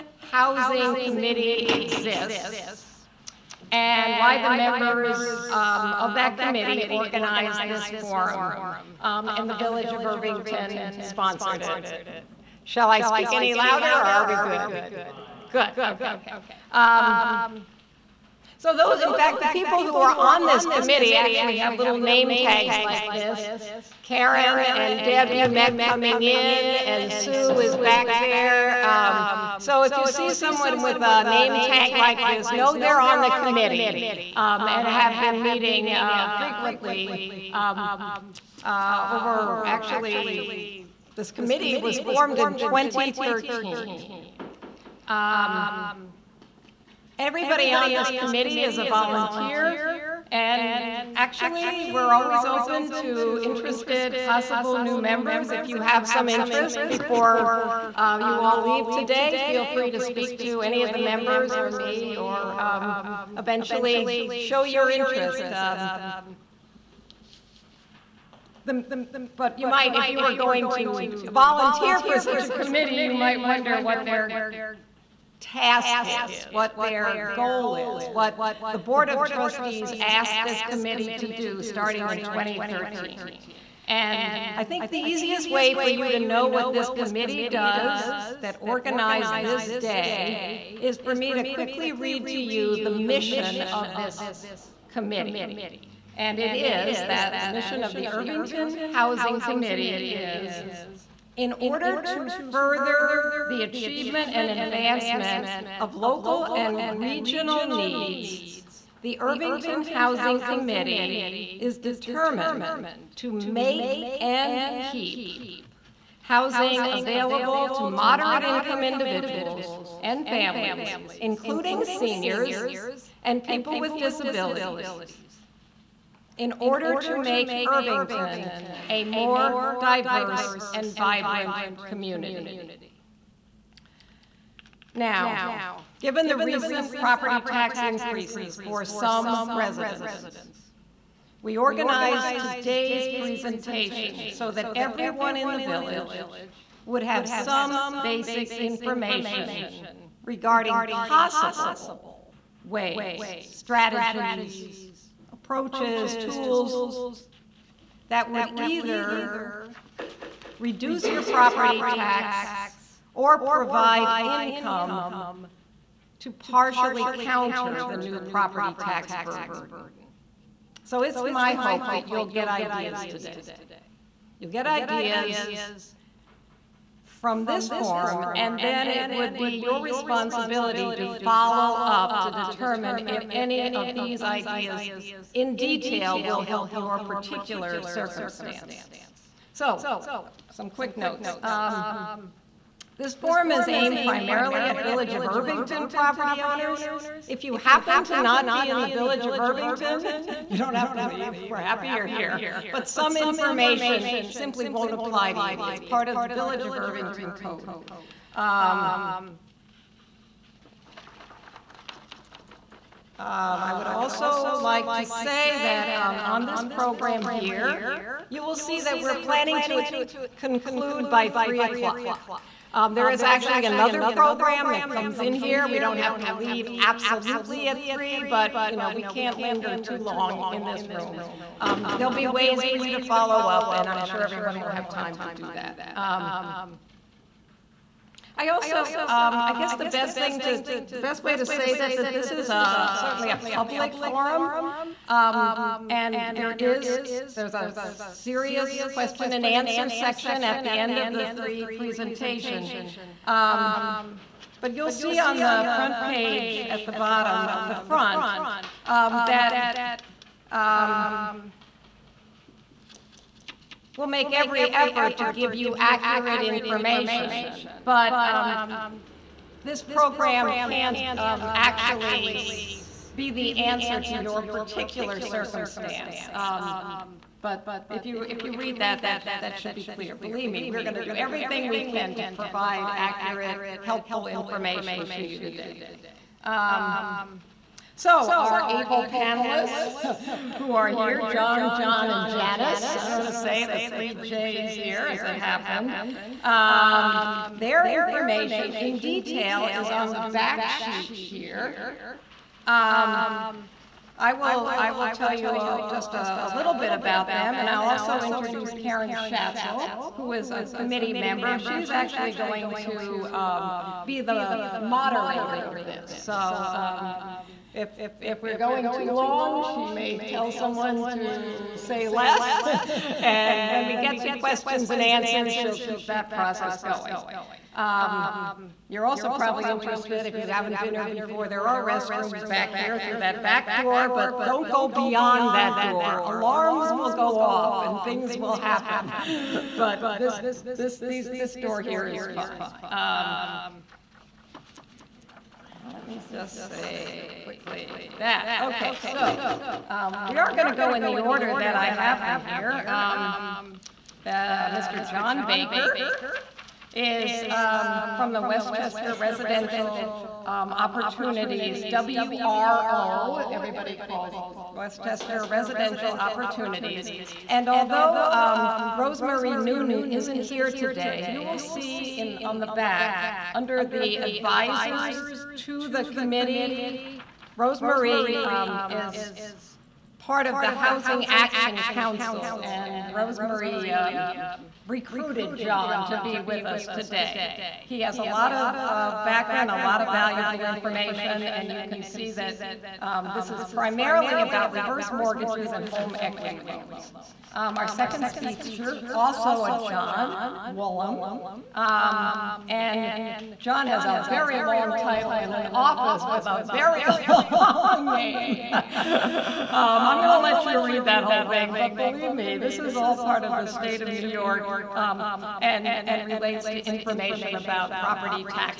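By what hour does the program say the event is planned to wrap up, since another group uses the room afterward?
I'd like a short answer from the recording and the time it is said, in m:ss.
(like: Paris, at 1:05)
3 o'clock, at 3:41.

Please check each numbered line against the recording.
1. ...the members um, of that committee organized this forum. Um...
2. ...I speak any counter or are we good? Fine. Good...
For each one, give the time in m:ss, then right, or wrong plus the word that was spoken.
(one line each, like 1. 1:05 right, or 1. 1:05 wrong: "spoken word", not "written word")
1. 0:04 right
2. 0:12 wrong: "louder", not "counter".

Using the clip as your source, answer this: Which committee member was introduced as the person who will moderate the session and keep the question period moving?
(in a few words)
Karen Schatzel.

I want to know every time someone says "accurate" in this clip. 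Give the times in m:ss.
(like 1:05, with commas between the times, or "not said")
4:25, 4:42.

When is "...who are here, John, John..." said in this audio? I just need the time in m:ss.
4:50.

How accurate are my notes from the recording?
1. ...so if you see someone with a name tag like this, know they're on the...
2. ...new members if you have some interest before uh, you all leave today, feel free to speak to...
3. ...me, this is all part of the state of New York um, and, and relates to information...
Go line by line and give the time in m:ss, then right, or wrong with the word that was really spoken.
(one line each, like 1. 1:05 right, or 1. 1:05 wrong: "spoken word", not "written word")
1. 0:29 right
2. 0:54 right
3. 6:52 right.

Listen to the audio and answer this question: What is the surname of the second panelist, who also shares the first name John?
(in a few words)
Woolham.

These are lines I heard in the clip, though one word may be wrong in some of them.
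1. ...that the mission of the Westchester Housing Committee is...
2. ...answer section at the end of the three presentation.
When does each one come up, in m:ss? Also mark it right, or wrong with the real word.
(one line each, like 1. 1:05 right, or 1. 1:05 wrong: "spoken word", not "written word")
1. 1:37 wrong: "Irvington", not "Westchester"
2. 4:09 right.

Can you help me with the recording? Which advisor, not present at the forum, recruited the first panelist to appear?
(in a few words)
Rosemary Newton.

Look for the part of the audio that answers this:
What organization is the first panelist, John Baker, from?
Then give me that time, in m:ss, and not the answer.
5:58.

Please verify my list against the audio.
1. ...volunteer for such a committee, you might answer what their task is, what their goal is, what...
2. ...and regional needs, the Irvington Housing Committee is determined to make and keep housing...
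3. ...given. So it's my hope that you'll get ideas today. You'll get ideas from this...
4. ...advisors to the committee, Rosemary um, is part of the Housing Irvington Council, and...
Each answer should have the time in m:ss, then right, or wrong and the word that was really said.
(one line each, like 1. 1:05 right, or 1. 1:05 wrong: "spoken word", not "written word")
1. 1:11 wrong: "wonder", not "answer"
2. 1:46 right
3. 2:49 wrong: "burden", not "given"
4. 6:14 wrong: "Action", not "Irvington".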